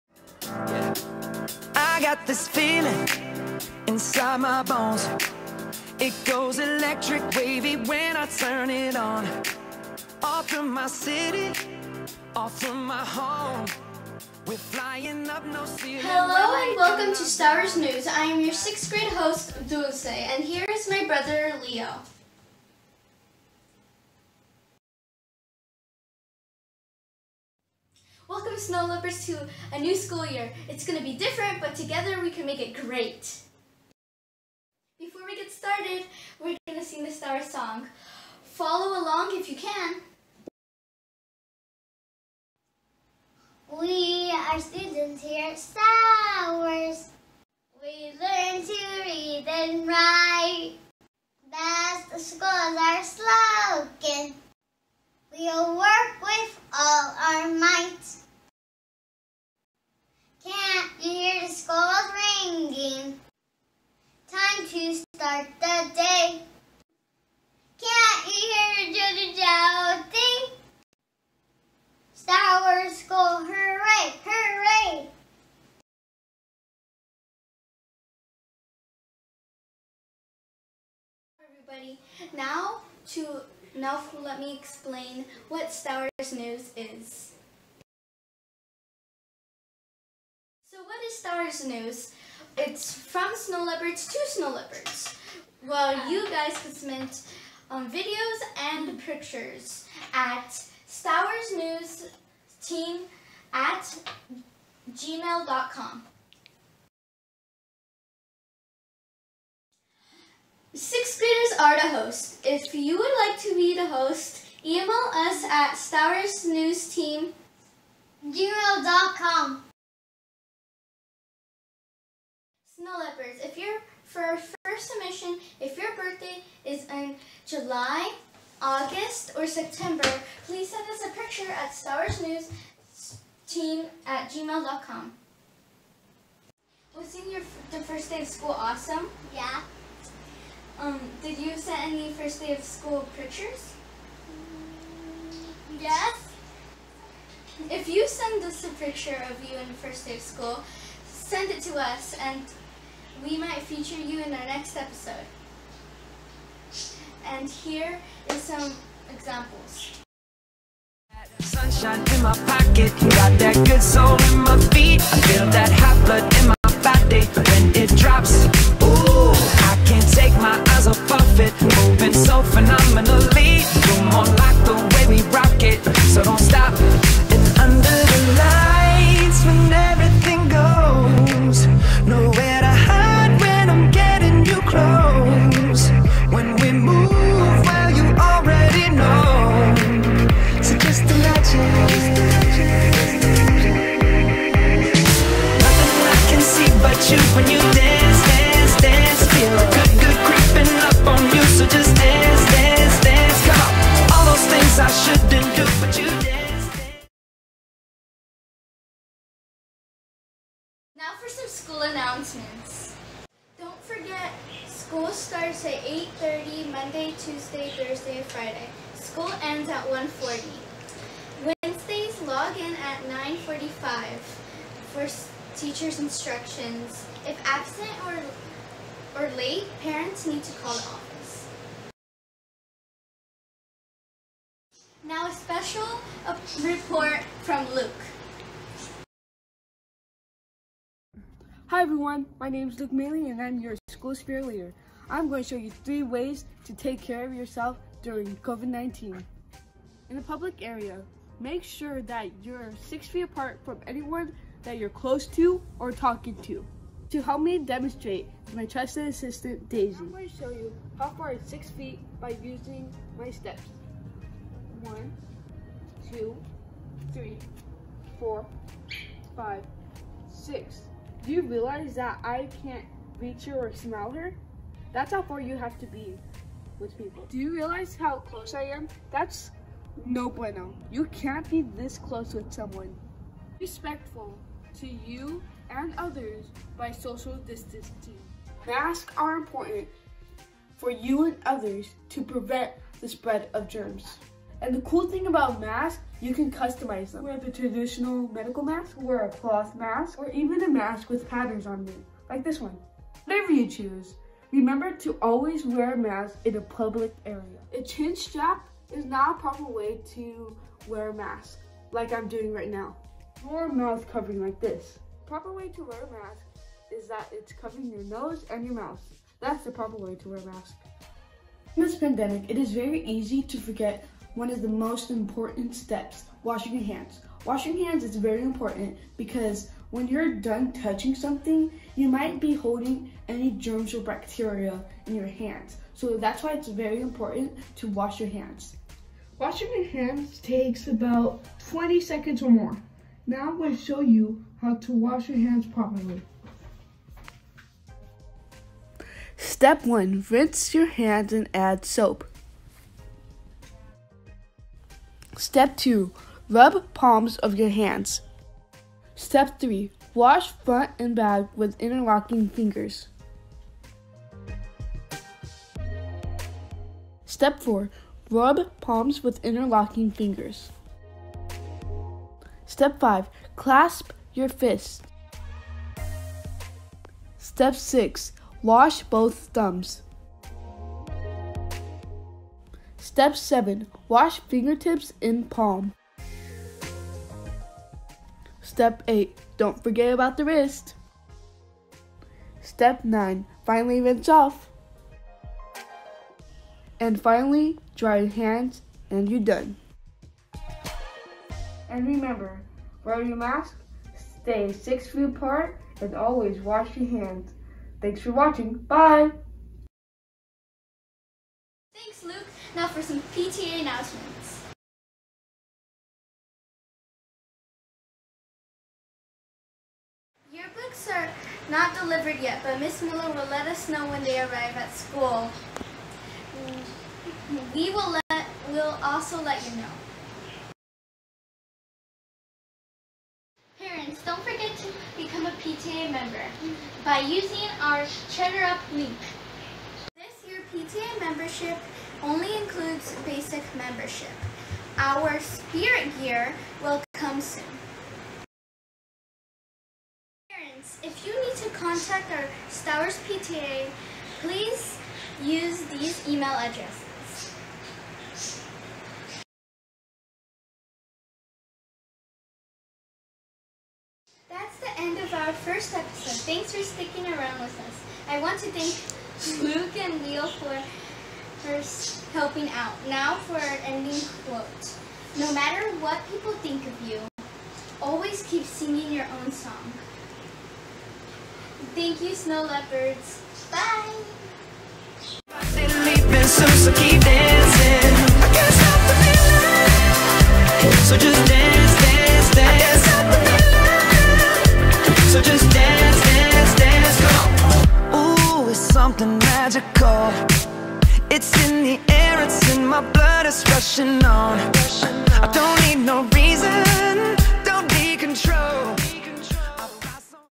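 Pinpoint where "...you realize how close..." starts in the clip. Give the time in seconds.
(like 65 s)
277 s.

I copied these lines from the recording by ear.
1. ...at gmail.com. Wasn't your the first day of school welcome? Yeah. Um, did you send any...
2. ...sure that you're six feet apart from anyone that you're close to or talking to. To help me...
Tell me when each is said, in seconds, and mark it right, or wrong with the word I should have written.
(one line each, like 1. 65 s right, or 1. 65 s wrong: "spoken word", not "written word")
1. 134 s wrong: "awesome", not "welcome"
2. 251 s right.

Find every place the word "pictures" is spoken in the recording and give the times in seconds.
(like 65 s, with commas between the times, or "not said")
98 s, 131 s, 143 s, 148 s.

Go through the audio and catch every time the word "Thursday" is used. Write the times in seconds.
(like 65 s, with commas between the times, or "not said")
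217 s.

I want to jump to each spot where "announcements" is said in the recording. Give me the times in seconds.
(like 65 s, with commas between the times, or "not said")
211 s, 413 s.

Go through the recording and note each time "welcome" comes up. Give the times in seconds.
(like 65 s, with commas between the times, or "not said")
16 s, 28 s.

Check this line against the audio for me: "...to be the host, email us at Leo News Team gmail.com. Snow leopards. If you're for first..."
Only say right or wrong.
wrong.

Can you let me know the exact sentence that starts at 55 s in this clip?
We'll work with all our might.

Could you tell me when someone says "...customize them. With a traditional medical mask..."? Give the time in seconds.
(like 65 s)
296 s.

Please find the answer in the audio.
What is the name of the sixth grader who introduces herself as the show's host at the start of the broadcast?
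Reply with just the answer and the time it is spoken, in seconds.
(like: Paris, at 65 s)
Dulce, at 19 s.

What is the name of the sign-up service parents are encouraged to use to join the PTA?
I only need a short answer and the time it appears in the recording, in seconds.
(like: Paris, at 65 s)
Cheddar Up, at 438 s.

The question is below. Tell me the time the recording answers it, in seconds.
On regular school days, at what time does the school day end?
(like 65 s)
219 s.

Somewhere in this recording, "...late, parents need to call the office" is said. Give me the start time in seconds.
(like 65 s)
229 s.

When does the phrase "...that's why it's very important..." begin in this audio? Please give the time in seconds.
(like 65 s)
336 s.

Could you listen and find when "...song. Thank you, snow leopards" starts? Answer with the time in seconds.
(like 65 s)
479 s.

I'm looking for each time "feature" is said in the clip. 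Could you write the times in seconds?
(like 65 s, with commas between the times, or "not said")
153 s.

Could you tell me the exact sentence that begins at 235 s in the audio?
Now a special uh, report from Luke.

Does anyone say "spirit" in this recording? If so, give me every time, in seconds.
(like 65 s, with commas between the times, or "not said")
244 s, 445 s.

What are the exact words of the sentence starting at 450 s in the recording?
Parents, if you need to contact our Stowers PTA, please use these email addresses.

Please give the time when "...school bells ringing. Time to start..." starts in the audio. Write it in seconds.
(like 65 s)
61 s.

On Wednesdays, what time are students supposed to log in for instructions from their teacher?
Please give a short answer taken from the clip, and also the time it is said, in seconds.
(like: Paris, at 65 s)
9:45, at 223 s.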